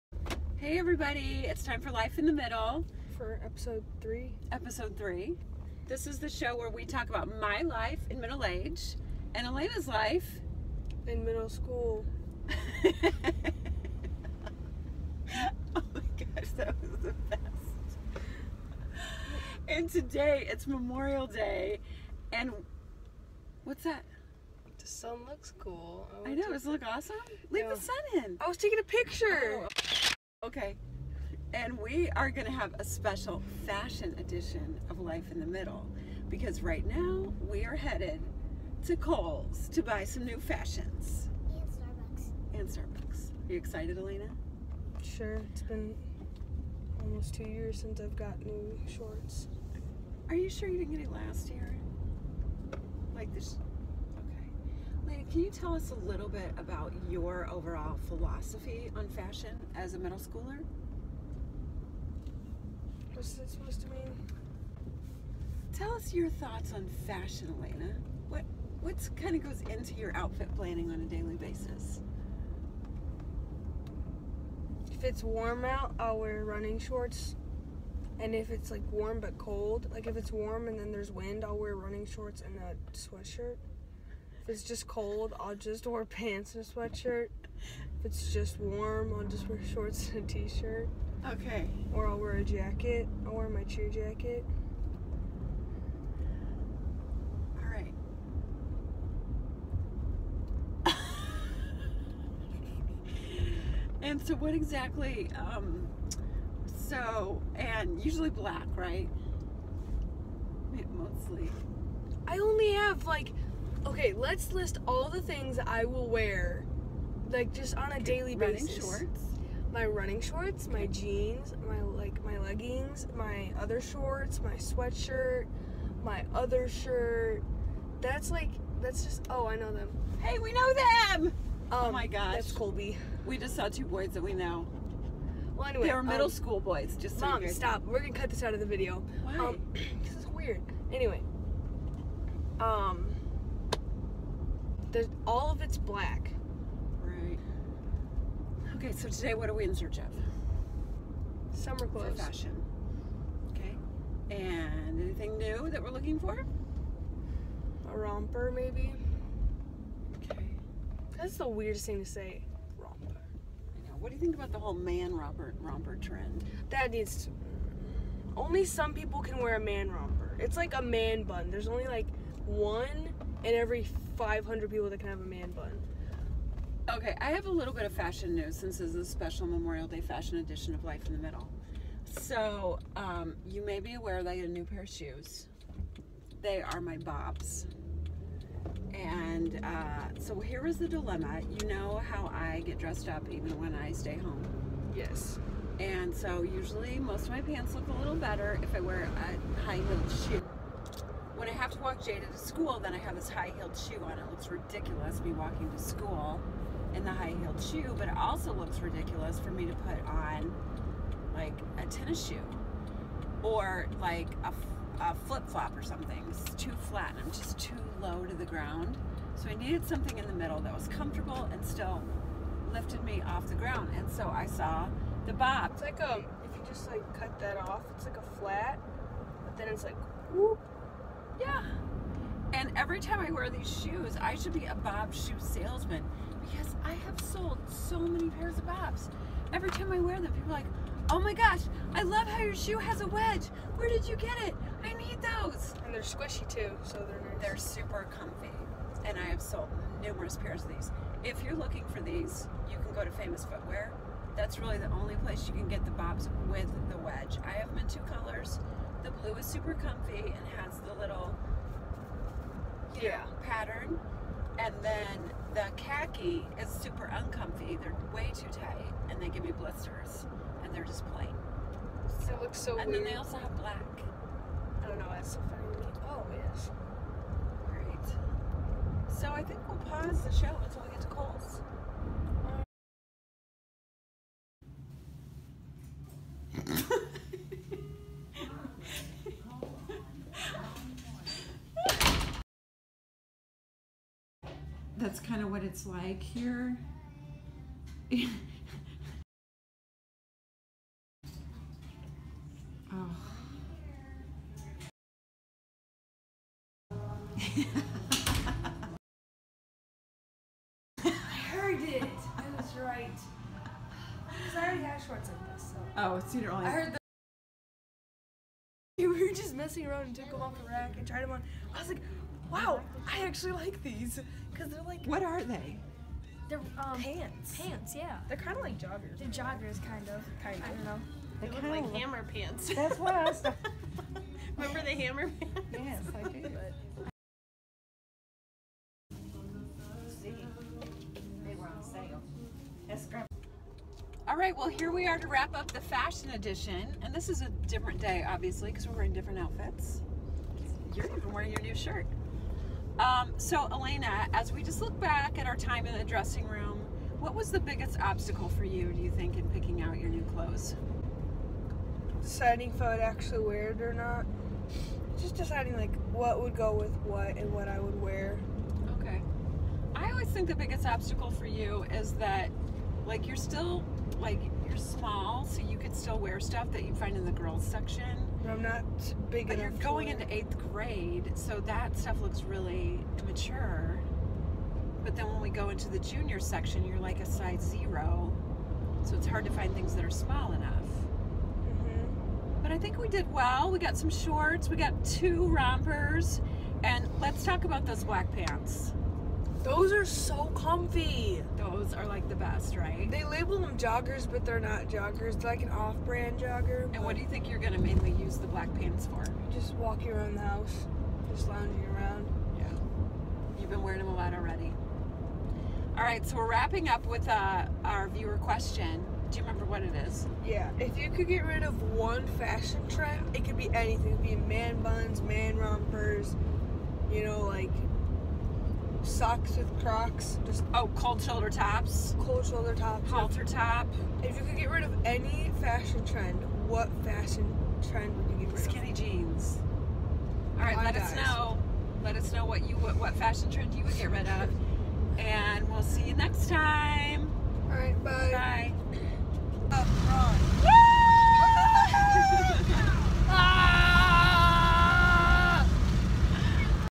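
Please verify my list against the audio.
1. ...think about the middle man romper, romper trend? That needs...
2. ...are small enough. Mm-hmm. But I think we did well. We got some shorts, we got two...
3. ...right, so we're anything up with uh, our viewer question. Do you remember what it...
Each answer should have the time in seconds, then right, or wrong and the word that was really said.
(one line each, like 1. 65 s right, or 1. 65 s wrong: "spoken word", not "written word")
1. 164 s wrong: "whole", not "middle"
2. 390 s right
3. 416 s wrong: "wrapping", not "anything".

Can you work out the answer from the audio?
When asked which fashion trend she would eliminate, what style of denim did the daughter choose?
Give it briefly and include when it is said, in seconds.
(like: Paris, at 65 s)
Skinny jeans, at 438 s.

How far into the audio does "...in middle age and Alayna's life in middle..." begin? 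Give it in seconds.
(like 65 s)
8 s.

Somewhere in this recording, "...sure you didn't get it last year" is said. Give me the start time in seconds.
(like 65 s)
50 s.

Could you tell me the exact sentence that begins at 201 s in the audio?
I have to walk Jada to school, then I have this high-heeled shoe on.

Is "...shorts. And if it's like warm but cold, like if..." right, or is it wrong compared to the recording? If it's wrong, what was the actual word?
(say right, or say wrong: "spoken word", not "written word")
right.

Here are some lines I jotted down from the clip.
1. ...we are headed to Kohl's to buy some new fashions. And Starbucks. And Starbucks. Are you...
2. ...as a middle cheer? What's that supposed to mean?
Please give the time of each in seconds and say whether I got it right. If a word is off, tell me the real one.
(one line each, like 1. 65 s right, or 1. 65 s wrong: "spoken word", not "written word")
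1. 37 s right
2. 59 s wrong: "schooler", not "cheer".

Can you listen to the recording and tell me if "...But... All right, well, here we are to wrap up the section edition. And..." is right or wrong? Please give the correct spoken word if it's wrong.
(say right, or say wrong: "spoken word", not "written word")
wrong: "fashion", not "section".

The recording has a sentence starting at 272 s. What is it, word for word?
So, it looks so and weird.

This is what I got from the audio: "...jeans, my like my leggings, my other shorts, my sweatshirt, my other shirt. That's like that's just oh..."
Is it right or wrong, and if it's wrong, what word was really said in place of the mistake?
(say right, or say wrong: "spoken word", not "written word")
right.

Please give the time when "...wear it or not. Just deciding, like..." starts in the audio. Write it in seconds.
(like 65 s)
363 s.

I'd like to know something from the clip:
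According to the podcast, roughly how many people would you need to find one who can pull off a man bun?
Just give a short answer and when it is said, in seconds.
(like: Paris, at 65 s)
500, at 174 s.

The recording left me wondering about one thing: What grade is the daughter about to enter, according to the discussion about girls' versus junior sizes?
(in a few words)
Eighth grade.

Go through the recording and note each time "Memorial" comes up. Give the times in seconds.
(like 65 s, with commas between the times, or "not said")
20 s, 179 s.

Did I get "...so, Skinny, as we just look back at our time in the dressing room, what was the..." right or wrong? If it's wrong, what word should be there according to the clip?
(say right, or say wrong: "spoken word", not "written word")
wrong: "Alayna", not "Skinny".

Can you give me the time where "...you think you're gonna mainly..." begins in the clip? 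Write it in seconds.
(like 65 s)
407 s.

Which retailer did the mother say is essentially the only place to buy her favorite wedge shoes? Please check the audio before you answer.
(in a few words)
Famous Footwear.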